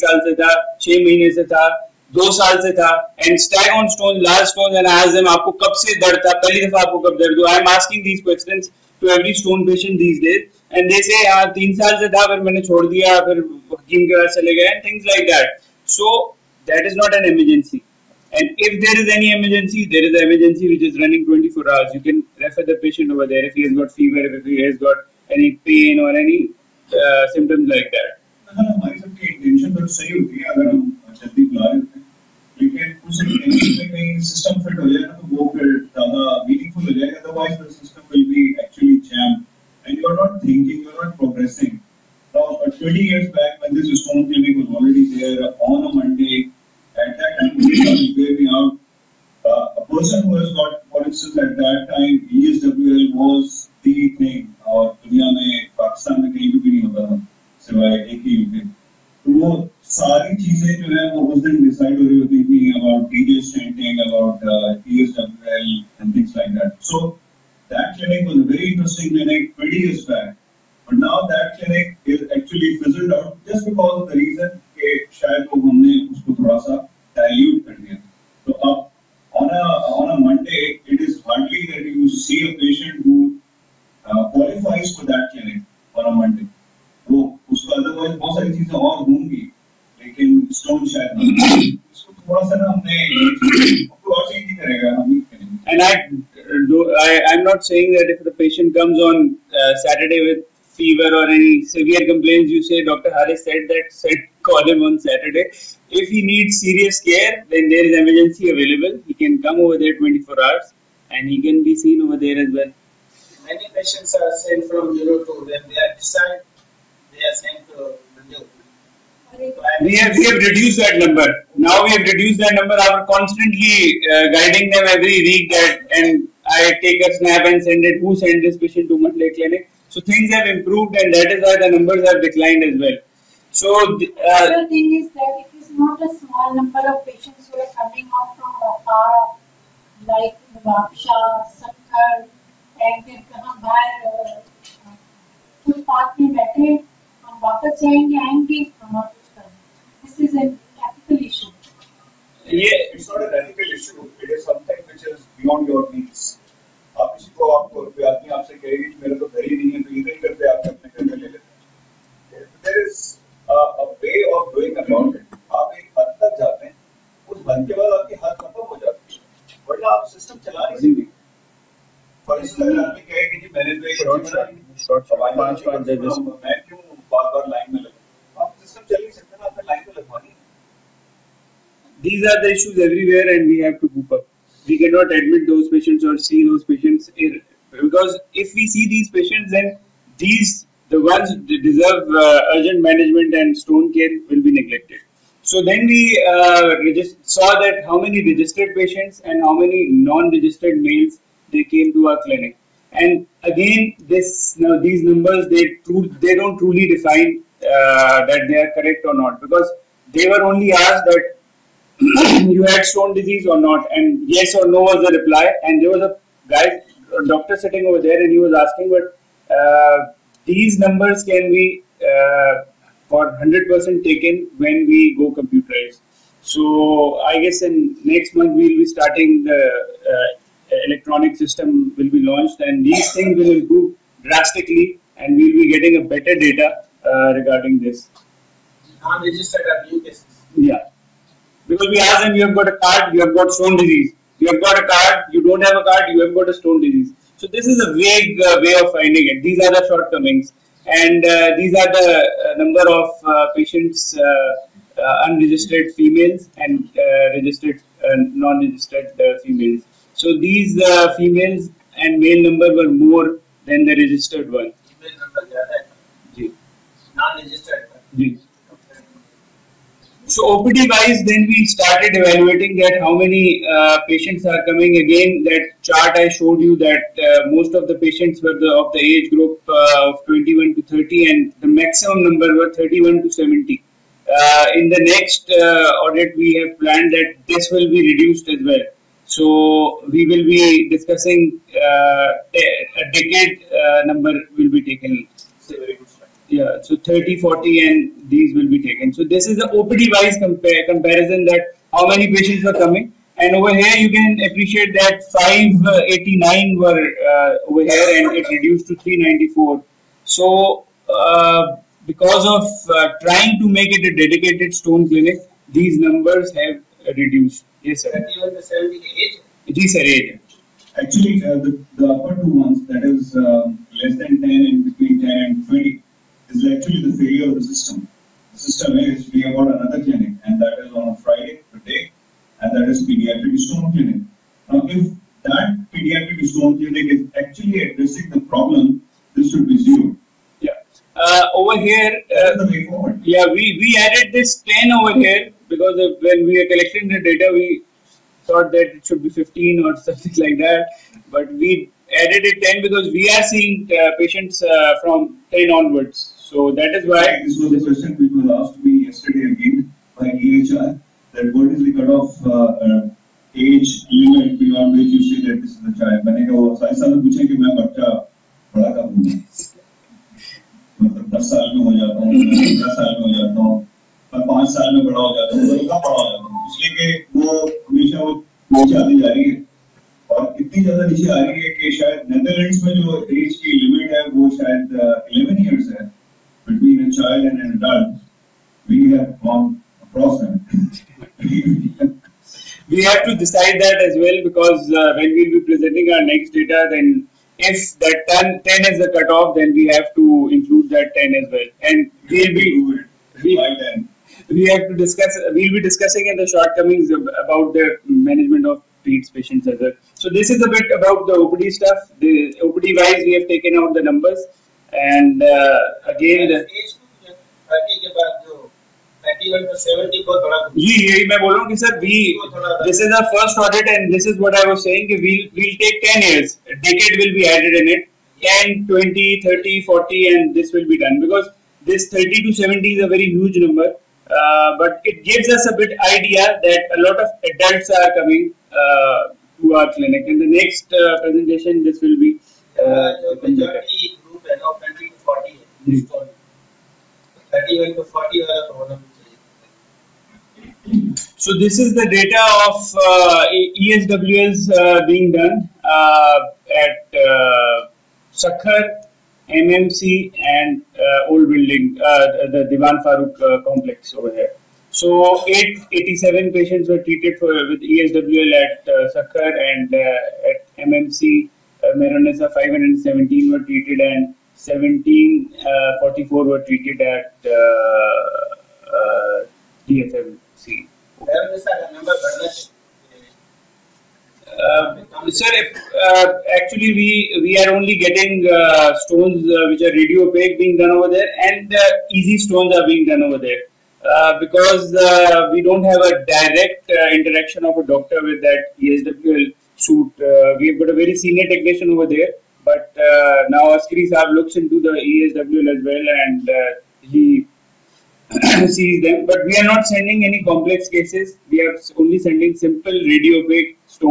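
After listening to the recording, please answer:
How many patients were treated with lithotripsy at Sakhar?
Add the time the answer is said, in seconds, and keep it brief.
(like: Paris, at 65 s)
887, at 465 s.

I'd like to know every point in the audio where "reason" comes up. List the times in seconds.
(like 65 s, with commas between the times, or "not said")
74 s.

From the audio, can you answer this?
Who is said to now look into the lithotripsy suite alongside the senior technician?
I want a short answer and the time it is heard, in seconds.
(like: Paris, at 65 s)
Askari Saab, at 503 s.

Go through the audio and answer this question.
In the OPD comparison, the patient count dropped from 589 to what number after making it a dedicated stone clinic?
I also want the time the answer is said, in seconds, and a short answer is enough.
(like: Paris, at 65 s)
394, at 308 s.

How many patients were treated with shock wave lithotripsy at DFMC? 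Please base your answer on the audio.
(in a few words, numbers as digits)
1744.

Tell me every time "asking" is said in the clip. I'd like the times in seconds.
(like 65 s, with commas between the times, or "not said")
7 s, 218 s.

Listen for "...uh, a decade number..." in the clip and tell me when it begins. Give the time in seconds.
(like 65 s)
291 s.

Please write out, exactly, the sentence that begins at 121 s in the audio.
Now we have reduced that number.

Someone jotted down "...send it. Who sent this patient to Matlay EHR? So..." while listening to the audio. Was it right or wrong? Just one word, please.
wrong.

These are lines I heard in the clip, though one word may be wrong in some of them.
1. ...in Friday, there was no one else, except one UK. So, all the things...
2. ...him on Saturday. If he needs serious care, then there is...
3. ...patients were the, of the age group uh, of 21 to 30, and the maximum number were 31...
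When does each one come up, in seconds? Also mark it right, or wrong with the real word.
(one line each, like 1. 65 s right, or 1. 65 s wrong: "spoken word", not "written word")
1. 55 s wrong: "Pakistan", not "Friday"
2. 104 s right
3. 277 s right.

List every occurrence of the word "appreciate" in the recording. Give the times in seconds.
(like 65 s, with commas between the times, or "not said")
304 s.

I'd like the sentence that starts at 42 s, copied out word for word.
Now, 20 years back, when this responsibility was already there on a Monday, at that time, you gave me out.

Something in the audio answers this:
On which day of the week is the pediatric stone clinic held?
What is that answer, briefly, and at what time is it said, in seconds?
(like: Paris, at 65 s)
Friday, at 331 s.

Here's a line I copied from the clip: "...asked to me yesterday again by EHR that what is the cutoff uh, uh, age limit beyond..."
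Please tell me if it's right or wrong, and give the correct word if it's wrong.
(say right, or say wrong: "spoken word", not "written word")
right.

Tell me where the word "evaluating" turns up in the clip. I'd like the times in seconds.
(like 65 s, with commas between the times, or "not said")
272 s.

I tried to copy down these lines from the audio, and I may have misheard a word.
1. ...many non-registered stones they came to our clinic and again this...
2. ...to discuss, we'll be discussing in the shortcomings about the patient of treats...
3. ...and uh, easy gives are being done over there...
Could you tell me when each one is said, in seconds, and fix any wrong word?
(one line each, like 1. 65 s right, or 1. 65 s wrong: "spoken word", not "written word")
1. 199 s wrong: "males", not "stones"
2. 404 s wrong: "management", not "patient"
3. 491 s wrong: "stones", not "gives".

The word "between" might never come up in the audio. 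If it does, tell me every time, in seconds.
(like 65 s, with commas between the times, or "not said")
324 s, 386 s.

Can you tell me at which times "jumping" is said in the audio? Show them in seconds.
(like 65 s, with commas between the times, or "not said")
not said.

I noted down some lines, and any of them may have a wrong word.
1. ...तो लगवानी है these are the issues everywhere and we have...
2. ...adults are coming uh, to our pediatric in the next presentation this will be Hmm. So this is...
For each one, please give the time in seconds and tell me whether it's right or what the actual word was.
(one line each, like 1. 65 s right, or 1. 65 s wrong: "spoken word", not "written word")
1. 179 s right
2. 437 s wrong: "clinic", not "pediatric".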